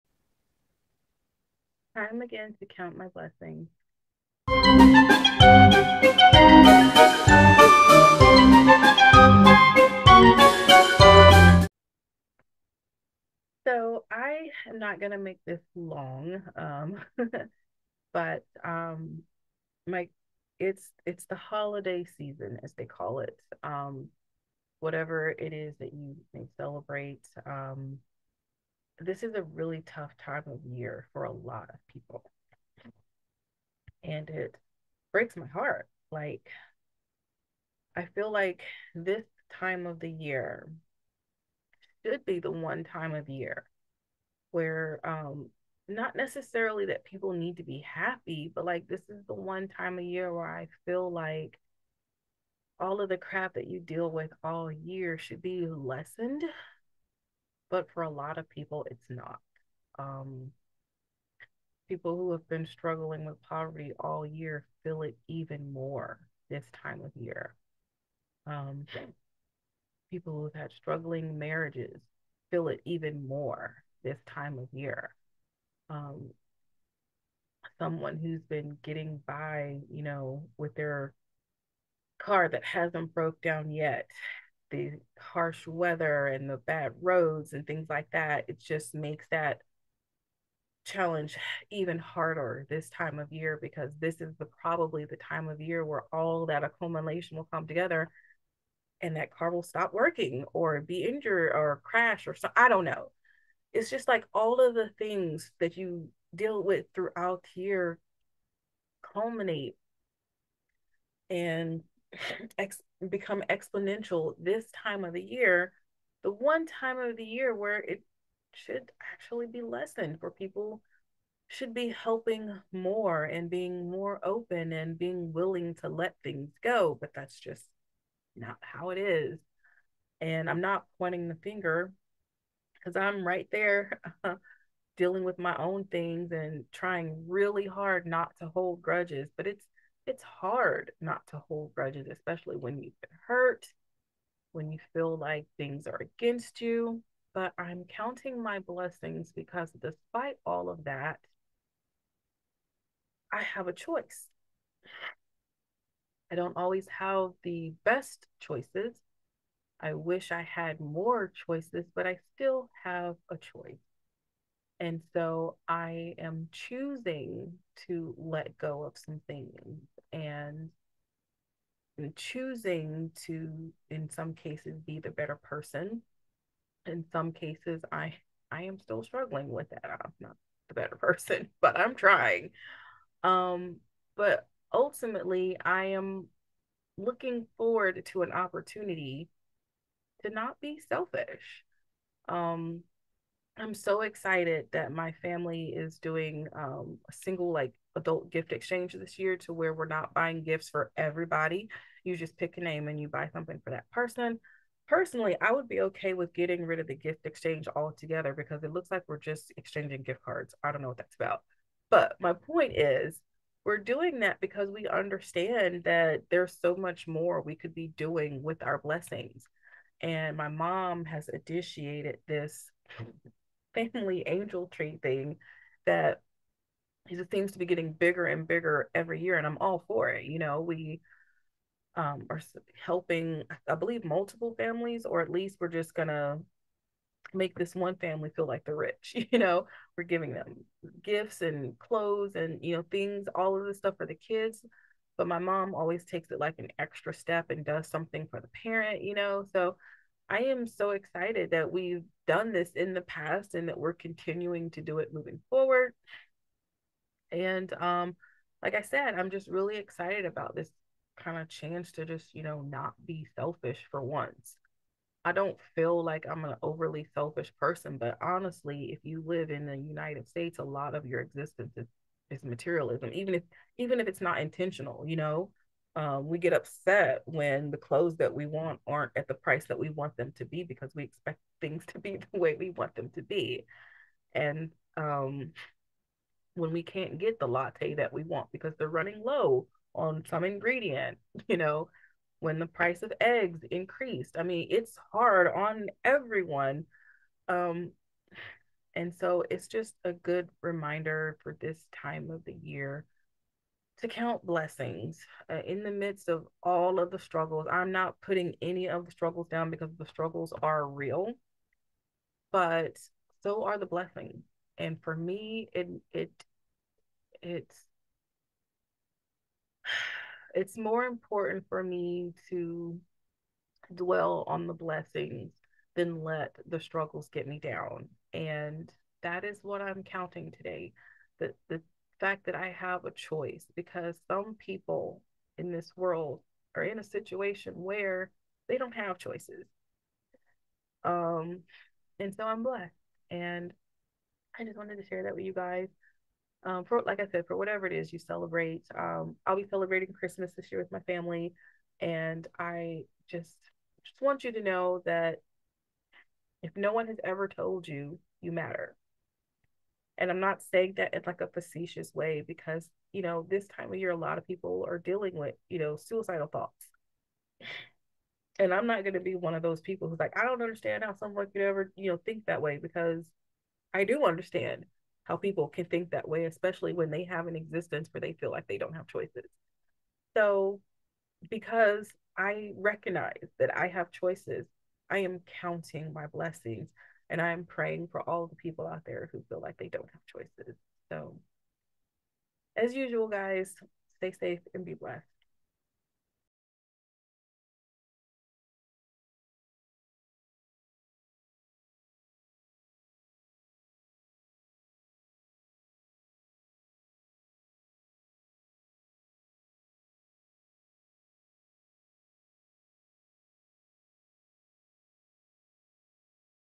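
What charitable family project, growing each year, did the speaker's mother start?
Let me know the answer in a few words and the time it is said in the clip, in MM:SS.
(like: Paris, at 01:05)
family angel tree, at 03:43.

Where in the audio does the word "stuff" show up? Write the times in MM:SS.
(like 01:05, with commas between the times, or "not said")
04:03.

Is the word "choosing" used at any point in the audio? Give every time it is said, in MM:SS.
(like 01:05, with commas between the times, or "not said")
02:46, 02:52.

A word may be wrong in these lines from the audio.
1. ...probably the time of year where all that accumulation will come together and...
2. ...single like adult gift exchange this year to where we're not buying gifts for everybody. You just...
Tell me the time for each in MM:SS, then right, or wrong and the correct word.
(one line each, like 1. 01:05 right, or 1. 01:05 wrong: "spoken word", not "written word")
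1. 01:34 right
2. 03:17 right.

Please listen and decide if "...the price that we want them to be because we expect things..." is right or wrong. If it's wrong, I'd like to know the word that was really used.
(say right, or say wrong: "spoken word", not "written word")
right.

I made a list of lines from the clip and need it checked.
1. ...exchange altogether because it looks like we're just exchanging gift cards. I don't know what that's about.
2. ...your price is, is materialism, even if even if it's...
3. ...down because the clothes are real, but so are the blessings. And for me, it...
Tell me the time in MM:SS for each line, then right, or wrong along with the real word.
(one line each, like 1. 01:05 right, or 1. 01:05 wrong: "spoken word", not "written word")
1. 03:27 right
2. 04:31 wrong: "existence", not "price"
3. 05:09 wrong: "struggles", not "clothes".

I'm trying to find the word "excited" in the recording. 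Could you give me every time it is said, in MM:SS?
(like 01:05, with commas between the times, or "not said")
03:14, 04:10, 04:19.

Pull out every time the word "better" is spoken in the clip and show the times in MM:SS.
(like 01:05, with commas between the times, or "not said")
02:55, 03:00.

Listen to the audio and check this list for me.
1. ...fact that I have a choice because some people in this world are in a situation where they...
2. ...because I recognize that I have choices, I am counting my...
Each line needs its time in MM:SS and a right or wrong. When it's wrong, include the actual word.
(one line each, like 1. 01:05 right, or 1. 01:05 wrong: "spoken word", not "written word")
1. 05:32 right
2. 06:21 right.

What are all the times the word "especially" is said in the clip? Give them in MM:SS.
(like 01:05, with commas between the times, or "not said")
02:22, 06:16.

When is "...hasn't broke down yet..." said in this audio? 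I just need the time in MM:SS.
01:22.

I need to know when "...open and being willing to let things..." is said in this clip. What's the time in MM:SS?
02:04.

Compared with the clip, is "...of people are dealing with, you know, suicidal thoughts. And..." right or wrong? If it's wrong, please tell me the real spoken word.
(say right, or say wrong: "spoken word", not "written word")
right.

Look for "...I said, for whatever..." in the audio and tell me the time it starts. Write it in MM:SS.
05:47.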